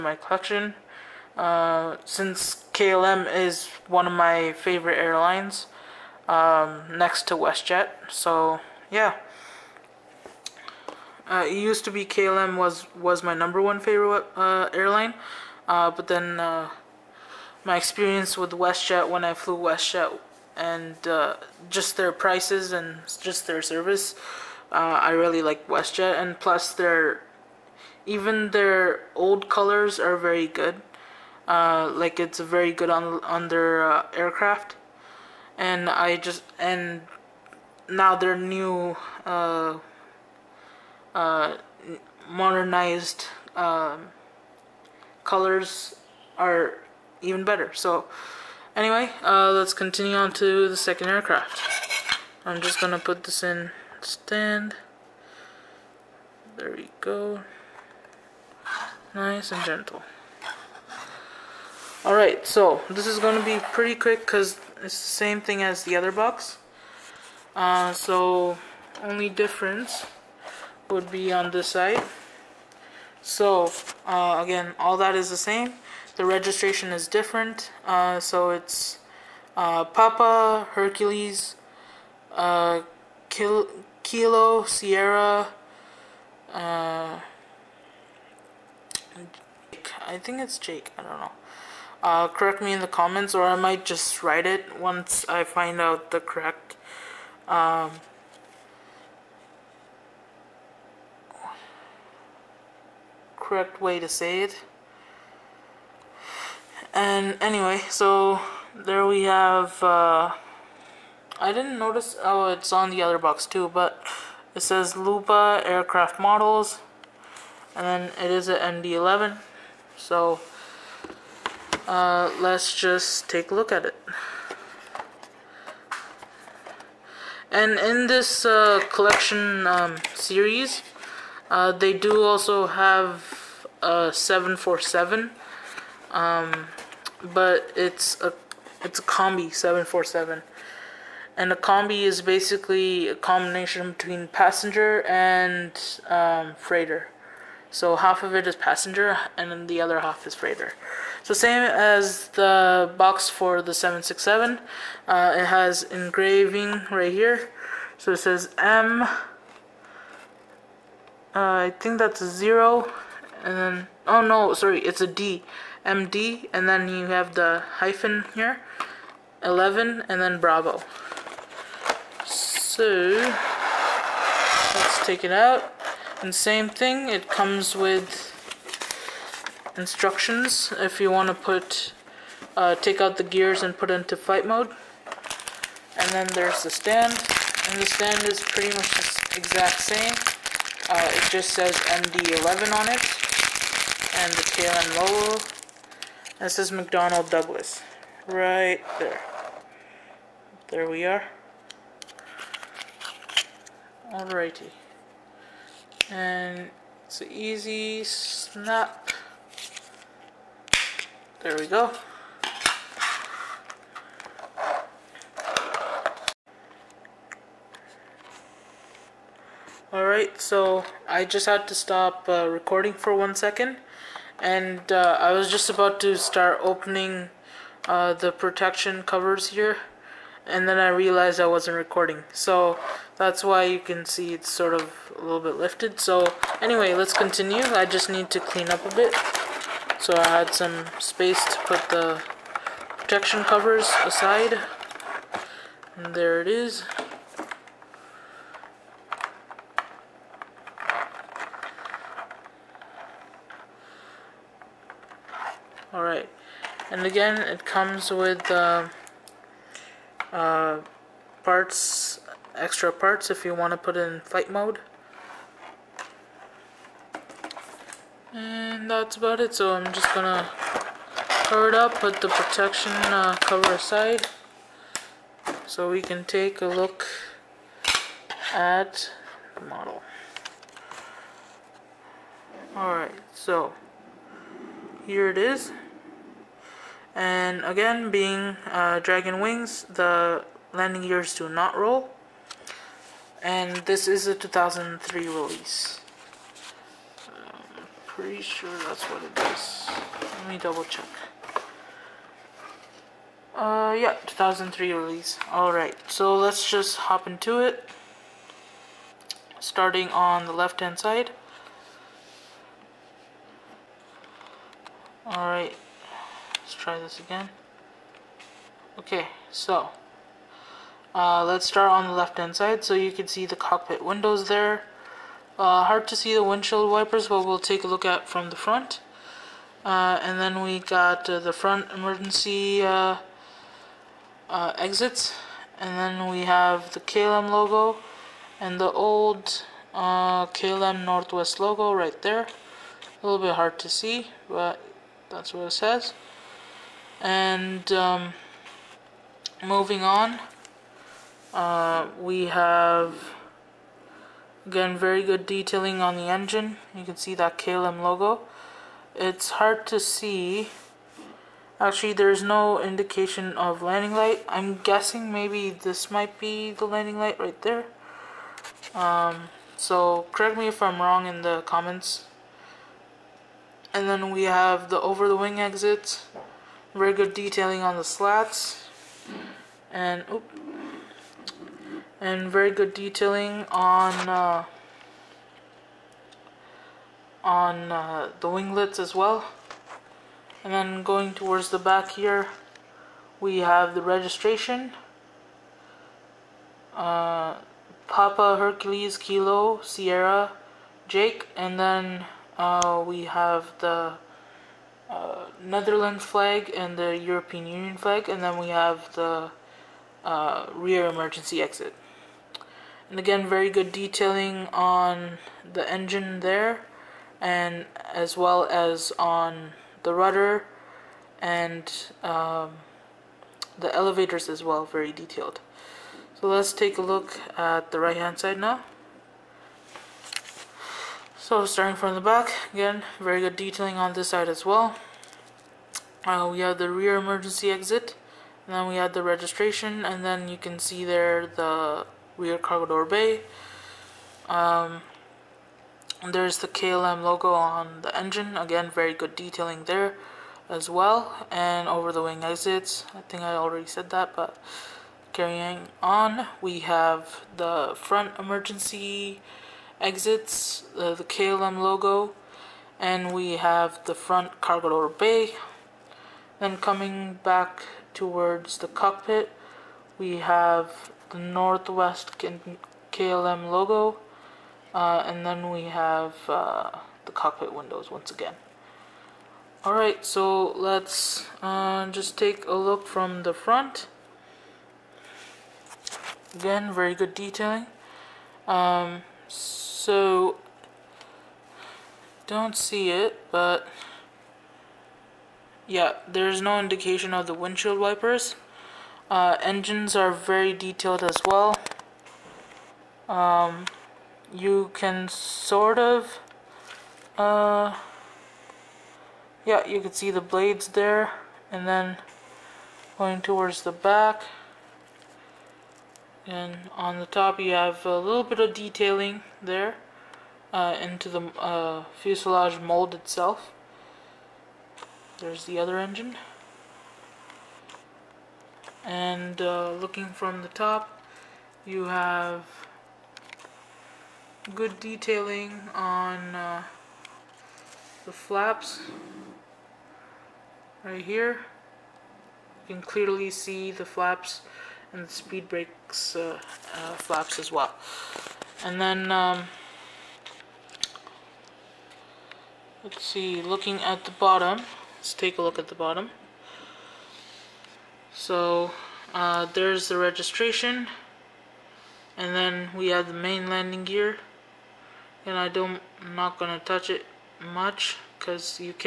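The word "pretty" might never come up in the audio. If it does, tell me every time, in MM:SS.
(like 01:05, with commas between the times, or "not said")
01:03, 03:08, 04:58.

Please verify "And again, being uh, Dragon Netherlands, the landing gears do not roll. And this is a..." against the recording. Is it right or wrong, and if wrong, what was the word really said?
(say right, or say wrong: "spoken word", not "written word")
wrong: "Wings", not "Netherlands".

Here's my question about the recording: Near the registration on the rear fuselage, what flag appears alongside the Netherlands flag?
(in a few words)
European Union.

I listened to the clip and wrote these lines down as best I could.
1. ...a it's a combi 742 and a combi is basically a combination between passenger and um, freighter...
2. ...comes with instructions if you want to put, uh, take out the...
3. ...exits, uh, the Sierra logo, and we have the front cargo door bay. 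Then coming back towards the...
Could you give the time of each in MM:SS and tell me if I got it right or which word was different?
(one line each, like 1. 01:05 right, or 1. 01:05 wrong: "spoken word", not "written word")
1. 02:18 wrong: "747", not "742"
2. 02:57 right
3. 07:40 wrong: "KLM", not "Sierra".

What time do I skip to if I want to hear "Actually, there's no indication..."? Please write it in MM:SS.
06:01.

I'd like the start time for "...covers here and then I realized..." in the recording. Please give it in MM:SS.
03:49.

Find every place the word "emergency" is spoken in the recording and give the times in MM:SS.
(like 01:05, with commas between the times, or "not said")
05:31, 06:51, 07:17, 07:38.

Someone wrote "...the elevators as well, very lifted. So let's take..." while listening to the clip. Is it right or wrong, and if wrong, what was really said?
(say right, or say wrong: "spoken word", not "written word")
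wrong: "detailed", not "lifted".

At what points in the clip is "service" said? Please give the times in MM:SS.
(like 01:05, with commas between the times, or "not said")
00:23.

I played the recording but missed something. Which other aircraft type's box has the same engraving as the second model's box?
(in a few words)
767.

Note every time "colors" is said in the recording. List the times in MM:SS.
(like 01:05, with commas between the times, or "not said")
00:29, 00:45.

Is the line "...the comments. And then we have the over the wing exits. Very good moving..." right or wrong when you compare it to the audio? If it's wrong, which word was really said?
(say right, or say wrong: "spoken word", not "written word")
wrong: "detailing", not "moving".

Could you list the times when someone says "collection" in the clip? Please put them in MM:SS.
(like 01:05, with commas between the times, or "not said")
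00:00, 02:08.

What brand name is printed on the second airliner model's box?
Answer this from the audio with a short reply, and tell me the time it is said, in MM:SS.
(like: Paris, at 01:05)
Lupa Aircraft Models, at 01:54.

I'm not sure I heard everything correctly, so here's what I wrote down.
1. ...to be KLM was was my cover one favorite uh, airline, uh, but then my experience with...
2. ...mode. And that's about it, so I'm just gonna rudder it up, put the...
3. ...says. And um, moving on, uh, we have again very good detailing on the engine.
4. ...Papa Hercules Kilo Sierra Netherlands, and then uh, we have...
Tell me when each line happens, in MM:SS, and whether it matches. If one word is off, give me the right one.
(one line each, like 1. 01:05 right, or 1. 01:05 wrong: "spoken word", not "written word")
1. 00:11 wrong: "number", not "cover"
2. 04:24 wrong: "cover", not "rudder"
3. 05:45 right
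4. 06:38 wrong: "Jake", not "Netherlands".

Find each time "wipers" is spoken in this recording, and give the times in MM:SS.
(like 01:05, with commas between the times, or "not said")
05:26, 08:17.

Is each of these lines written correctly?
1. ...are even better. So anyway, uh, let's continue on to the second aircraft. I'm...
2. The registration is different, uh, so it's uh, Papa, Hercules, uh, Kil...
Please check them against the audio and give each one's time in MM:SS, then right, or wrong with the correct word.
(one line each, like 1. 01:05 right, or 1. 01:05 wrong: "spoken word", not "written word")
1. 00:46 right
2. 01:16 right.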